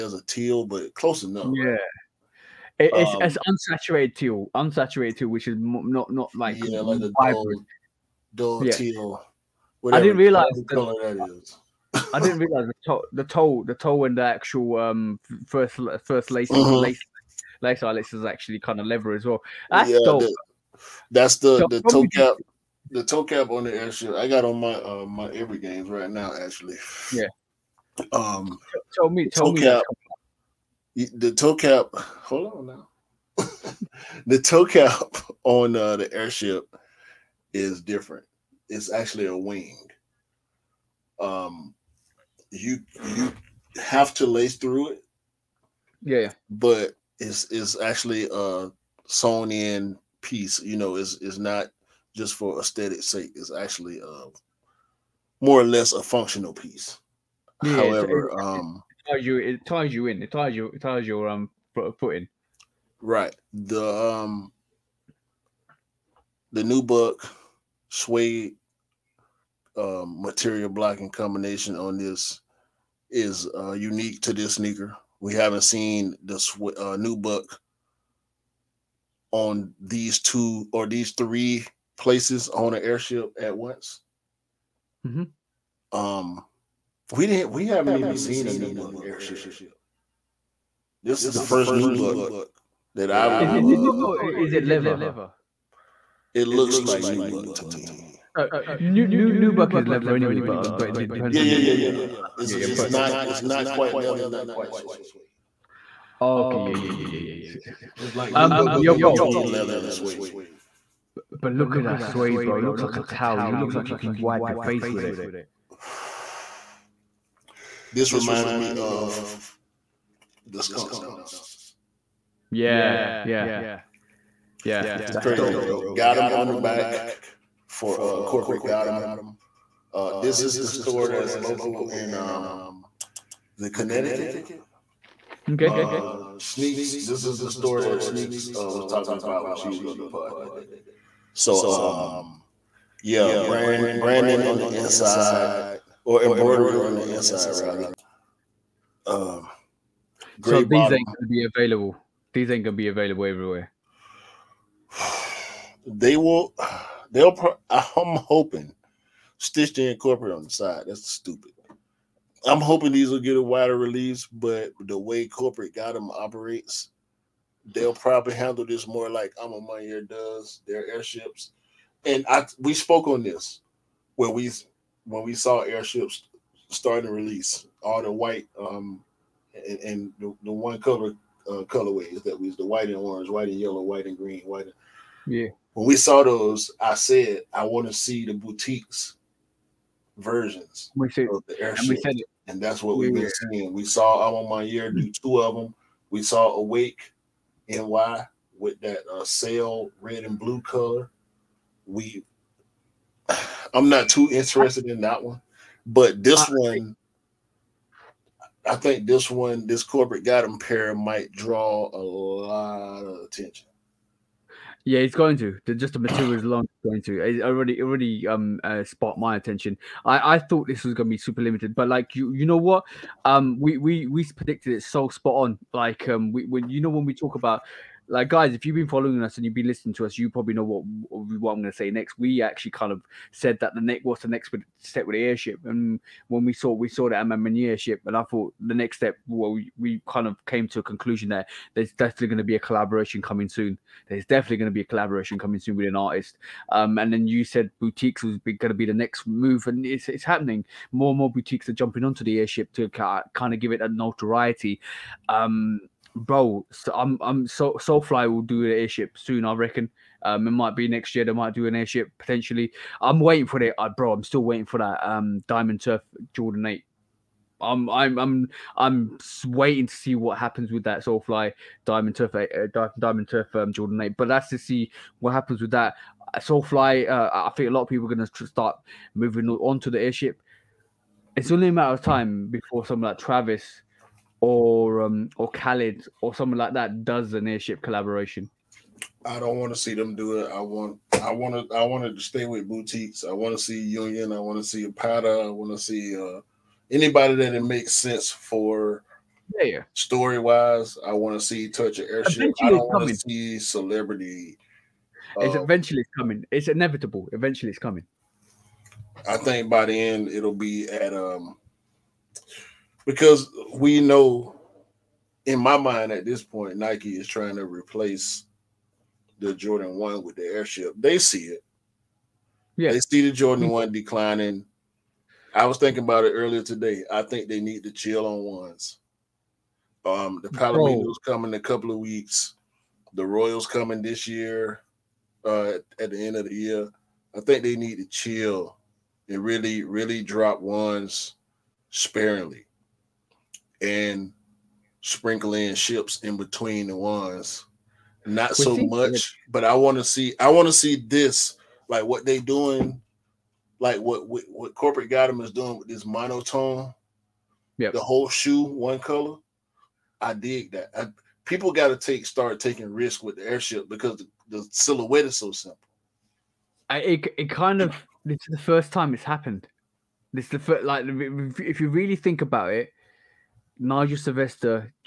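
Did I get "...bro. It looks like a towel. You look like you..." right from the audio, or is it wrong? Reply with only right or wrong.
right.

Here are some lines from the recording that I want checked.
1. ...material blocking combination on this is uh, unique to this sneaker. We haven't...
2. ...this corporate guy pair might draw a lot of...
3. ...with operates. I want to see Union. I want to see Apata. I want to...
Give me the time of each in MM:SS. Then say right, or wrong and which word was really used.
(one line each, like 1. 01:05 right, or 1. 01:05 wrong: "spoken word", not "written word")
1. 01:10 right
2. 03:29 right
3. 04:52 wrong: "boutiques", not "operates".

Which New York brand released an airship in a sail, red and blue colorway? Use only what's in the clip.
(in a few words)
Awake NY.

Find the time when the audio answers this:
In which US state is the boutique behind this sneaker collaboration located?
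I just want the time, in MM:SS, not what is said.
02:13.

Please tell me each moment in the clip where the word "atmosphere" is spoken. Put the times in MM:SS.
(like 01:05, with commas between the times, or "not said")
not said.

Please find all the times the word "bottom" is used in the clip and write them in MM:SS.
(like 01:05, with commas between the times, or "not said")
02:30.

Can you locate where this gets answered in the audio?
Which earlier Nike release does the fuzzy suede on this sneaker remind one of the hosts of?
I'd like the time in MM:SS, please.
02:00.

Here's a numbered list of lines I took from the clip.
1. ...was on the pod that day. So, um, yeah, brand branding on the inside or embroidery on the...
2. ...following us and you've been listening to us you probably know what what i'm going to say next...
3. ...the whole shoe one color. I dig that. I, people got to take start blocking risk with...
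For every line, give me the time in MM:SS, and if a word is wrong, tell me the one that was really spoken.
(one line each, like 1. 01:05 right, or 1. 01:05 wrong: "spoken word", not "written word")
1. 02:19 right
2. 03:48 right
3. 05:57 wrong: "taking", not "blocking".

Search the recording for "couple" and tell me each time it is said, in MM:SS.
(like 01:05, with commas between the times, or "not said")
05:31.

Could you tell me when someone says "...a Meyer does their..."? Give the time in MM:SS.
02:49.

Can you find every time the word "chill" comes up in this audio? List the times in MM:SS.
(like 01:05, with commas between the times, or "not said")
05:27, 05:38.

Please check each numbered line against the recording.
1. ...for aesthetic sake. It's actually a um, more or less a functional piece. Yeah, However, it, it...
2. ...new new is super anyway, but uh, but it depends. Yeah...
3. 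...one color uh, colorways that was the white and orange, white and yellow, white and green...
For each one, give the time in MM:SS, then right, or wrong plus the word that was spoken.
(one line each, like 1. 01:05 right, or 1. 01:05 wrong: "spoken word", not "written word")
1. 00:52 right
2. 01:39 wrong: "leather", not "super"
3. 03:00 right.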